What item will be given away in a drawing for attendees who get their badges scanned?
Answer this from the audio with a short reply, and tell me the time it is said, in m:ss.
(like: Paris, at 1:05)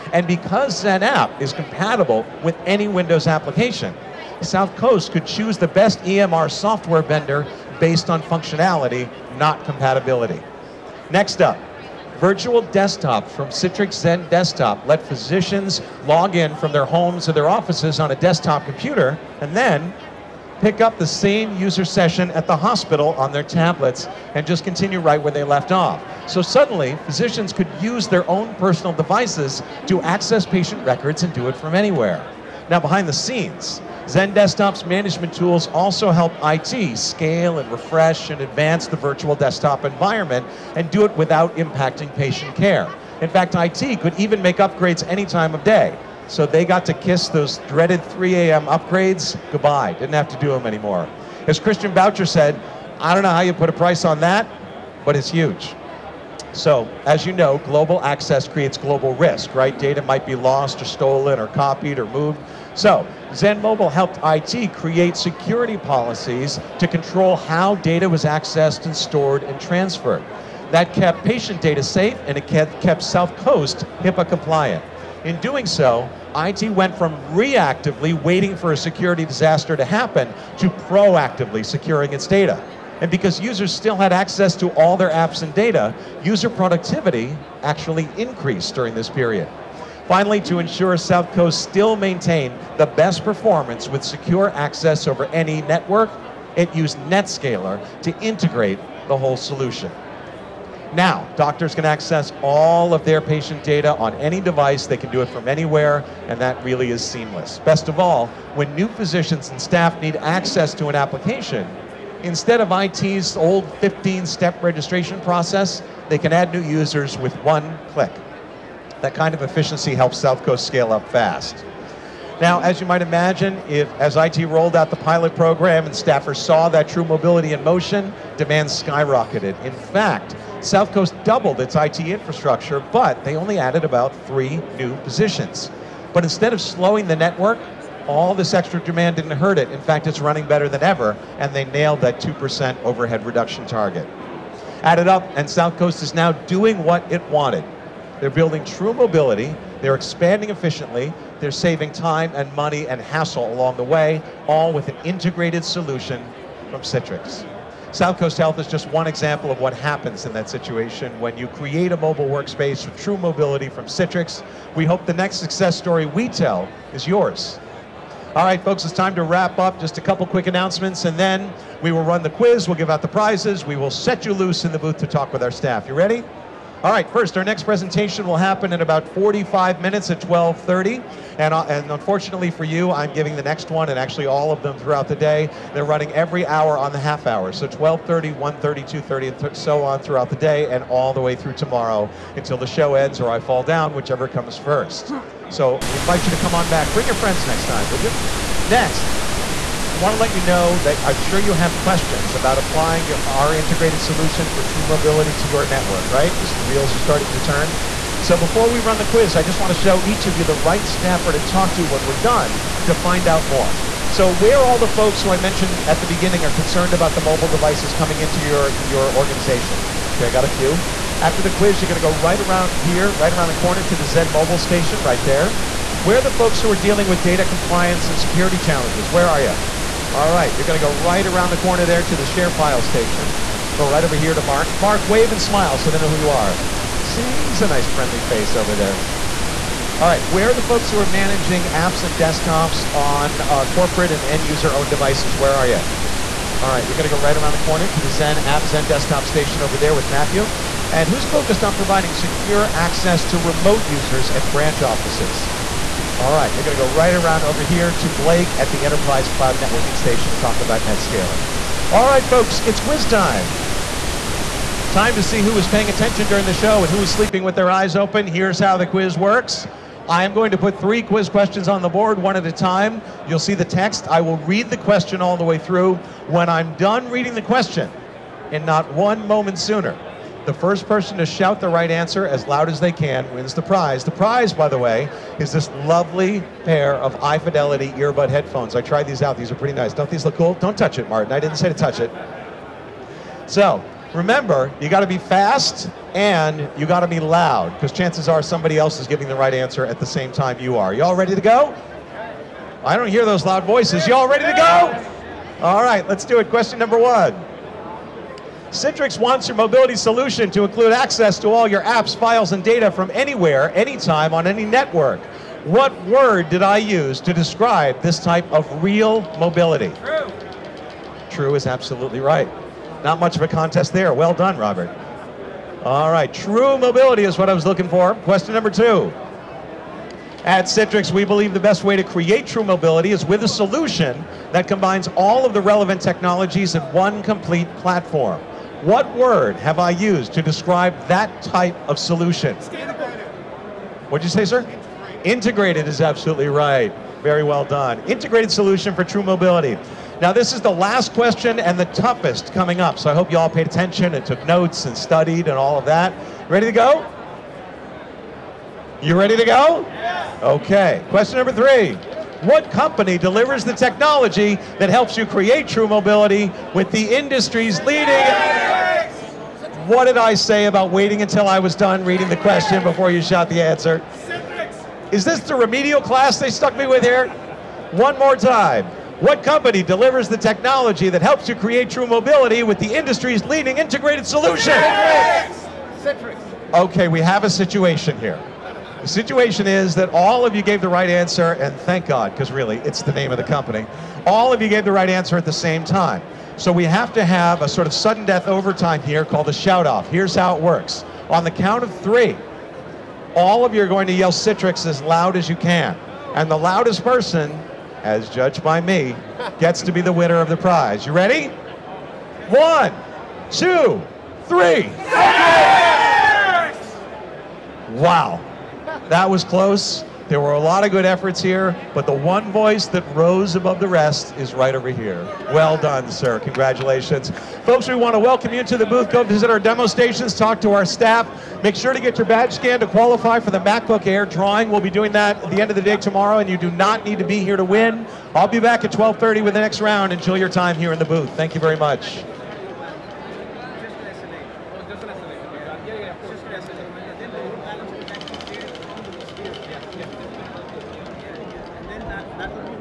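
MacBook Air, at 7:13.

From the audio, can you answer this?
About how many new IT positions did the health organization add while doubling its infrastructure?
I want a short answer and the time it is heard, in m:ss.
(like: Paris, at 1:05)
3, at 2:13.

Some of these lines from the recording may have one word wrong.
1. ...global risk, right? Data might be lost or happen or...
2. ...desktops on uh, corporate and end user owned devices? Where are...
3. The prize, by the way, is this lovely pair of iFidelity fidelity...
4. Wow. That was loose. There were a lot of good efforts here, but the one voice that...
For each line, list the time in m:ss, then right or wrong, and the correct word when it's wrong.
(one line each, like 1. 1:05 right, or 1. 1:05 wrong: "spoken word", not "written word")
1. 0:58 wrong: "stolen", not "happen"
2. 4:02 right
3. 4:44 right
4. 6:57 wrong: "close", not "loose".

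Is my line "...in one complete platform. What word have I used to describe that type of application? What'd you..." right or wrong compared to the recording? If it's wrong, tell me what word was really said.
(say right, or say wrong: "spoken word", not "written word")
wrong: "solution", not "application".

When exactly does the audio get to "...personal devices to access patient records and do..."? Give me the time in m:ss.
0:28.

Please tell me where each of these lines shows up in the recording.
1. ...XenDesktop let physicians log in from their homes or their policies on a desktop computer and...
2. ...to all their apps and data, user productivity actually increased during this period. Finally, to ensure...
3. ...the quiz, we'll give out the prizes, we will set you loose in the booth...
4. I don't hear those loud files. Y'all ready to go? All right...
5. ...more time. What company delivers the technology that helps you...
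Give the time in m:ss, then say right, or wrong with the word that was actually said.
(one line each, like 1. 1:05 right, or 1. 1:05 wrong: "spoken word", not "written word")
1. 0:13 wrong: "offices", not "policies"
2. 1:24 right
3. 2:52 right
4. 5:02 wrong: "voices", not "files"
5. 6:18 right.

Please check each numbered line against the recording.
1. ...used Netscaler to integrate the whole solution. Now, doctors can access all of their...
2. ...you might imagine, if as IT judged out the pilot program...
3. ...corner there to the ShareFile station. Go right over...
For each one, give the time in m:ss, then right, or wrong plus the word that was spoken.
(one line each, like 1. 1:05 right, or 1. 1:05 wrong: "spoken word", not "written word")
1. 1:36 right
2. 2:02 wrong: "rolled", not "judged"
3. 3:51 right.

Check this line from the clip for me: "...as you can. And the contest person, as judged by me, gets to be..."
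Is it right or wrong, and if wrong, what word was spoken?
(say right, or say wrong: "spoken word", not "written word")
wrong: "loudest", not "contest".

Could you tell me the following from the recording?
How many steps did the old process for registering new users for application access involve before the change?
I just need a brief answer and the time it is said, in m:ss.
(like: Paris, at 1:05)
15, at 1:53.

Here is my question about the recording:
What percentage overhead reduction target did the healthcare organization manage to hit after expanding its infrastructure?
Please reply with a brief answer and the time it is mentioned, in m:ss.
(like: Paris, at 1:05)
2%, at 2:22.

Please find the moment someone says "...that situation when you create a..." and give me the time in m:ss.
2:40.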